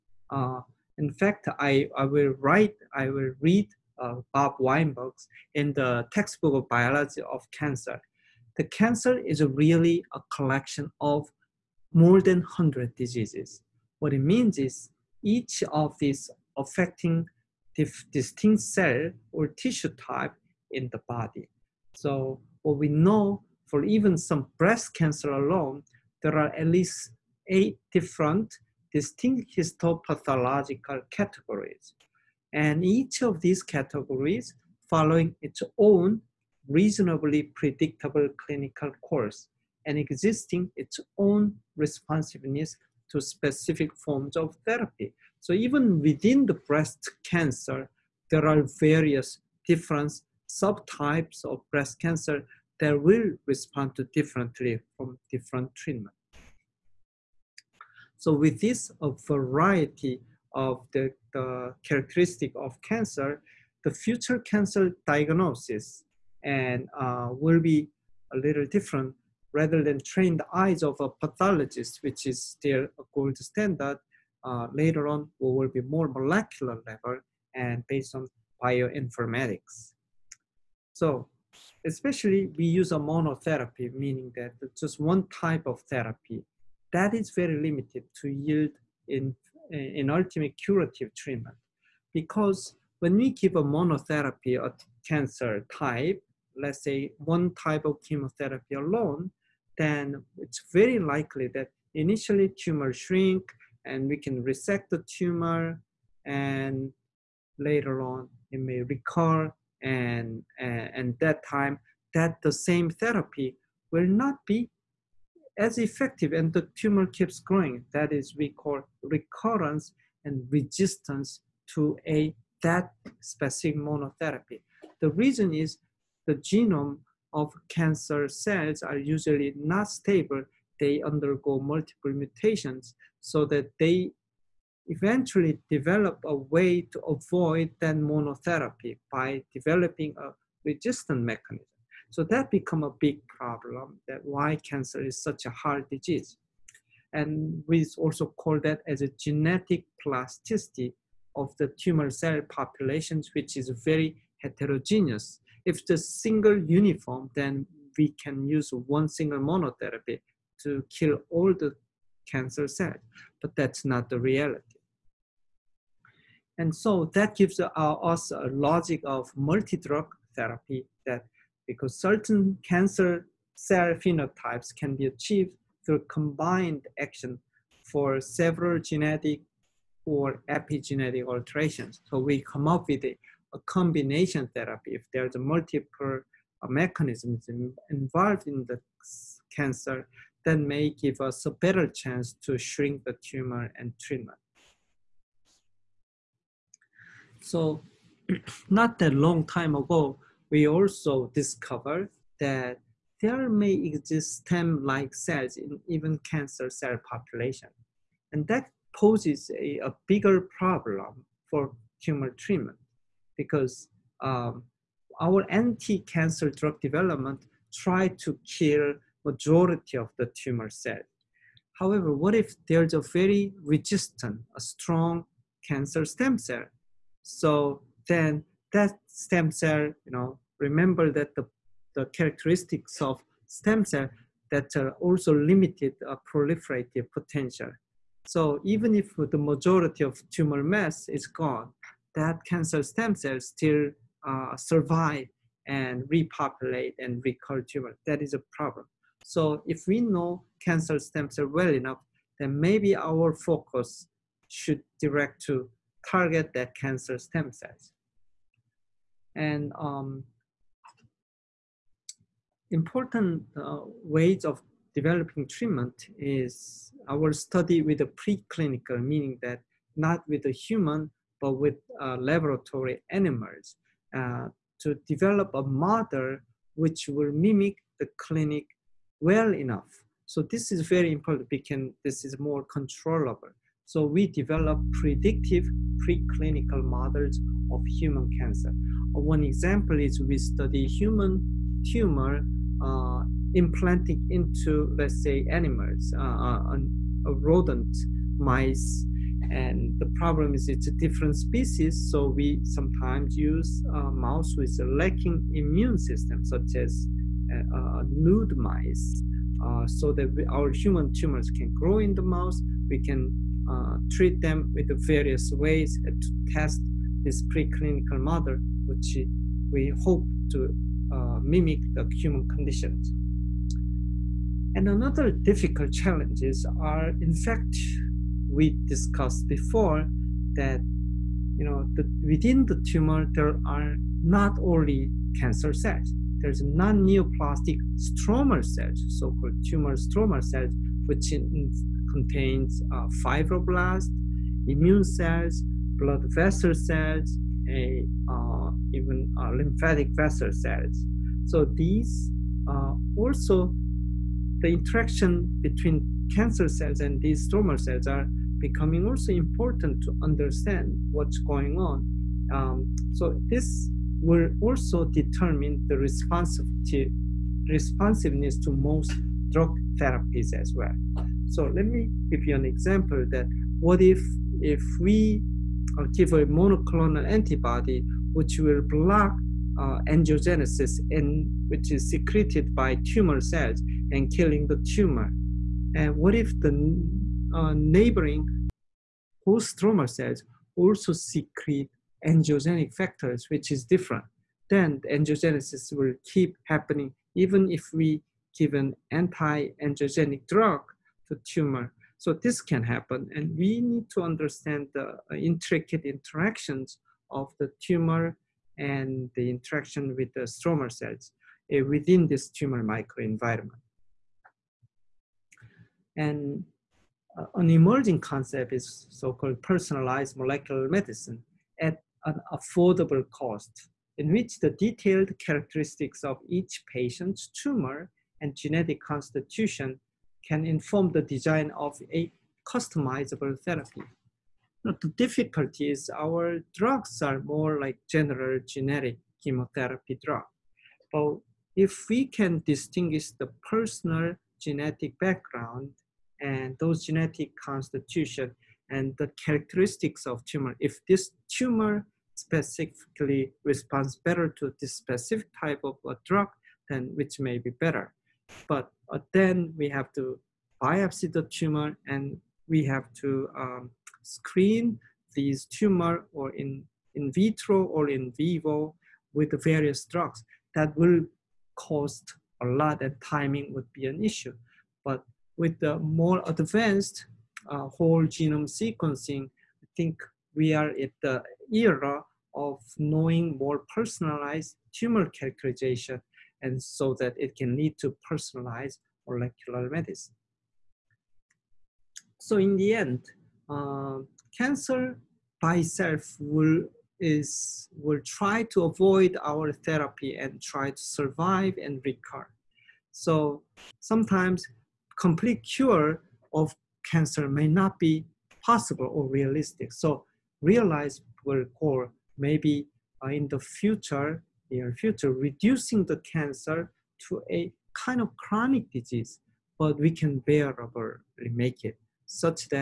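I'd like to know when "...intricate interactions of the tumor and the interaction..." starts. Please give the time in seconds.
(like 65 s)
405 s.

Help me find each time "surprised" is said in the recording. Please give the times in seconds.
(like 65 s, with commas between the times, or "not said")
not said.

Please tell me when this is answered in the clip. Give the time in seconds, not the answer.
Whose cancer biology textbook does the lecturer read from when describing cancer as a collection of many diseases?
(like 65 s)
4 s.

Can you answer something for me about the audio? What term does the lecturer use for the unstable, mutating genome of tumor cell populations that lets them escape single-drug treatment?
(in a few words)
genetic plasticity.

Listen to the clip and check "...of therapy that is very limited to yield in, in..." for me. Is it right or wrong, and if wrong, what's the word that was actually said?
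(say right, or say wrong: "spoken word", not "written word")
right.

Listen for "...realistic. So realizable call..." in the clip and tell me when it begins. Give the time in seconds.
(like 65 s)
509 s.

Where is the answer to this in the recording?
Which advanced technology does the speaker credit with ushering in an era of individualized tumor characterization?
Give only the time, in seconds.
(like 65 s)
477 s.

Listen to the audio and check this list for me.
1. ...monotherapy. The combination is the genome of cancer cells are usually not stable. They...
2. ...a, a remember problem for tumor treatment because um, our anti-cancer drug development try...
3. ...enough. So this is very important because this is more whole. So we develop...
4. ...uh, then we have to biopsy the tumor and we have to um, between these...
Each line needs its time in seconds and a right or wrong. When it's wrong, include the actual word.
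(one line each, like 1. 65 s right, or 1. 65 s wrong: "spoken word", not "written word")
1. 123 s wrong: "reason", not "combination"
2. 209 s wrong: "bigger", not "remember"
3. 279 s wrong: "controllable", not "whole"
4. 459 s wrong: "screen", not "between".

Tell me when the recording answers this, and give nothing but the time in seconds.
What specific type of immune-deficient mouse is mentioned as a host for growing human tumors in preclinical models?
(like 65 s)
308 s.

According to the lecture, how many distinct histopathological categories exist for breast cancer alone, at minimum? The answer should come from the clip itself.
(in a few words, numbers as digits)
8.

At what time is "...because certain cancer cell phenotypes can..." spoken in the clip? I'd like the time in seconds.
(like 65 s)
171 s.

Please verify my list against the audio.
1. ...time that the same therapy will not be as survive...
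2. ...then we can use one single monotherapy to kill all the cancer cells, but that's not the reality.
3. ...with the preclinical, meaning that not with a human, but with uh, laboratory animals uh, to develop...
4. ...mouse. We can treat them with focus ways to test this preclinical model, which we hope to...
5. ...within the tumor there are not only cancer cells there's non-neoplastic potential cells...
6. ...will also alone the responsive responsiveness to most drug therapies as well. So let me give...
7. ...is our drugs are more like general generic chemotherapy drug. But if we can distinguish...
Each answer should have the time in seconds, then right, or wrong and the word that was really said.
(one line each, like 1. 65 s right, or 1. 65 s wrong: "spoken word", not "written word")
1. 111 s wrong: "effective", not "survive"
2. 157 s right
3. 267 s right
4. 312 s wrong: "various", not "focus"
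5. 332 s wrong: "stromal", not "potential"
6. 364 s wrong: "determine", not "alone"
7. 435 s right.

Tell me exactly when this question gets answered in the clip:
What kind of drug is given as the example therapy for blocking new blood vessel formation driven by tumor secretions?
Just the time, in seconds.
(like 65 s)
376 s.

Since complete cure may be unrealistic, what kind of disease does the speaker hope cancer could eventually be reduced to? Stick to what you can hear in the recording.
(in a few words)
chronic disease.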